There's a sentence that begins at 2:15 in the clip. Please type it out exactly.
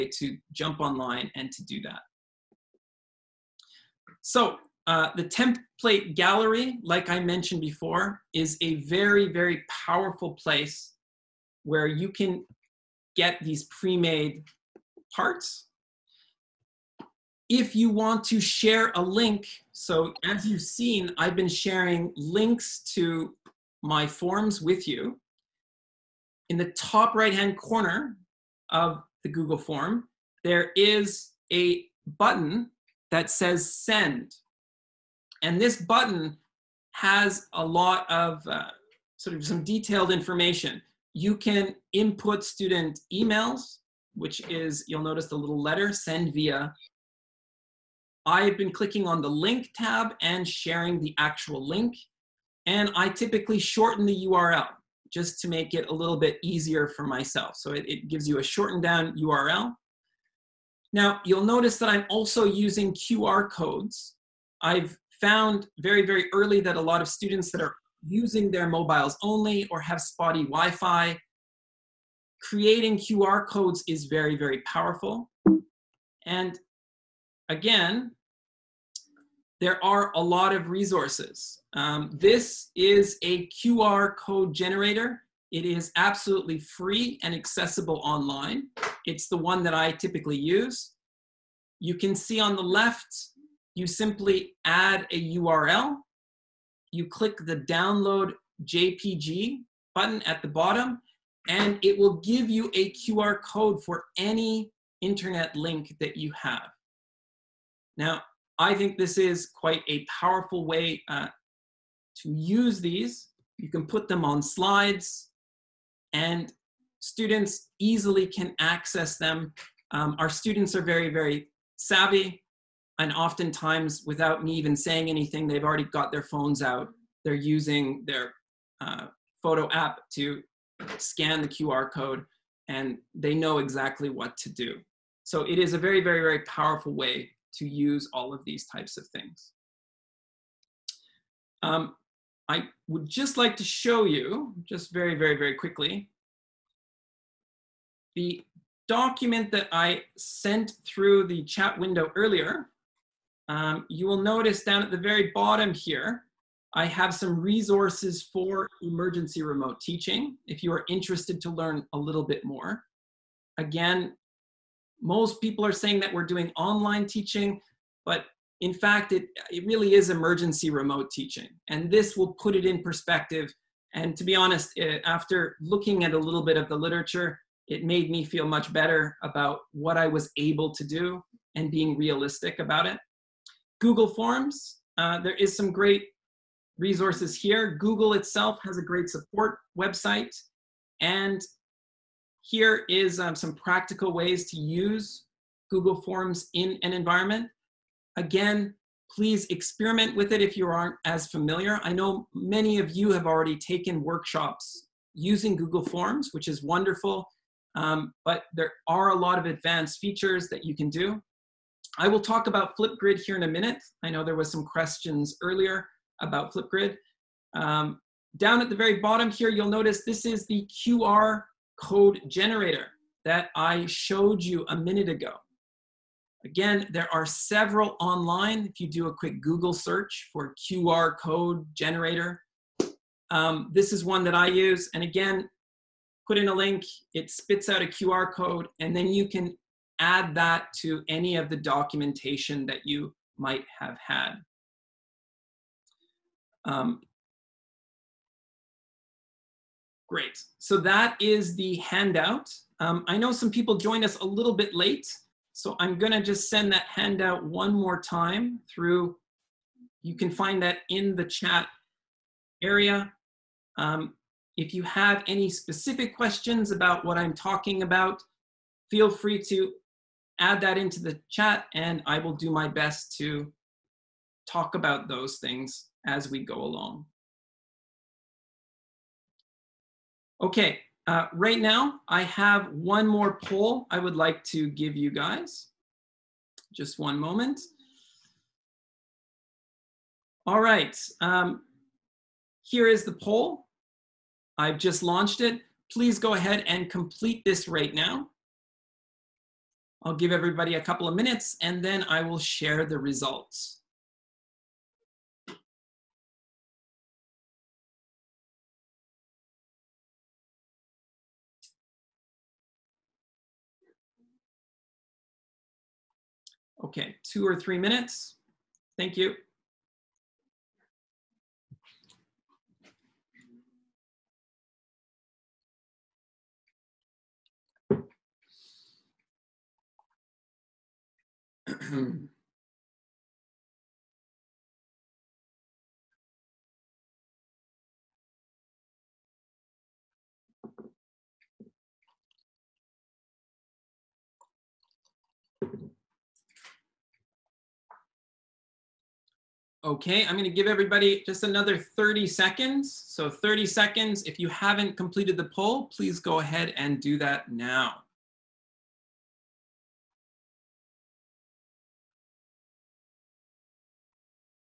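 So it is a very, very, very powerful way to use all of these types of things.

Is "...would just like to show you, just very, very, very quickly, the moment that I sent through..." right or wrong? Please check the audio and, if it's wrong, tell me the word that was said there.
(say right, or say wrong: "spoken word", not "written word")
wrong: "document", not "moment".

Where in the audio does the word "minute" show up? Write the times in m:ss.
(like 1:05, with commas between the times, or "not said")
3:33, 3:44, 5:01, 5:17.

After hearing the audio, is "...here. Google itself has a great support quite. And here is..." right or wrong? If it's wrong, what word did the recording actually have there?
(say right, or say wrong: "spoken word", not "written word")
wrong: "website", not "quite".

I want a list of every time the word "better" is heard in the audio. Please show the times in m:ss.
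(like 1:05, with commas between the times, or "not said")
2:58.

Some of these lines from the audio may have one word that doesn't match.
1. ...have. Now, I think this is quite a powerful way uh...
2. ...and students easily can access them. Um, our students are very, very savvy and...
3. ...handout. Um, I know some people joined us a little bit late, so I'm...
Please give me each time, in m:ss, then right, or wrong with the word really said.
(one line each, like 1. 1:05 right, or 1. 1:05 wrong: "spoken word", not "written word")
1. 1:46 right
2. 1:56 right
3. 4:11 right.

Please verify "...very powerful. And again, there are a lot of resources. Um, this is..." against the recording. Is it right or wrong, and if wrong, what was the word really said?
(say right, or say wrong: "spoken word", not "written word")
right.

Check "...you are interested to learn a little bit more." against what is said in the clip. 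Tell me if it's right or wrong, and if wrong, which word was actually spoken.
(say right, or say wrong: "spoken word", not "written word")
right.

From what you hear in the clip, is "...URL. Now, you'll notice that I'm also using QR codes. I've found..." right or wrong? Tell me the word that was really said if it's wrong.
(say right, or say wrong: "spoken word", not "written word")
right.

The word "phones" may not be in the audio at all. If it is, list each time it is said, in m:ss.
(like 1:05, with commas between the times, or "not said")
2:06.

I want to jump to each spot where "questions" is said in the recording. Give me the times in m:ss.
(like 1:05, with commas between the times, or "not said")
3:34, 4:26.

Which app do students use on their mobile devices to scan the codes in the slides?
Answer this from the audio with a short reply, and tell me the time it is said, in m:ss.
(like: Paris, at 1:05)
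Photo app, at 2:09.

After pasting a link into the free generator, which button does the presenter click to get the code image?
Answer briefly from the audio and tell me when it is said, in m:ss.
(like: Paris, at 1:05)
Download JPG, at 1:37.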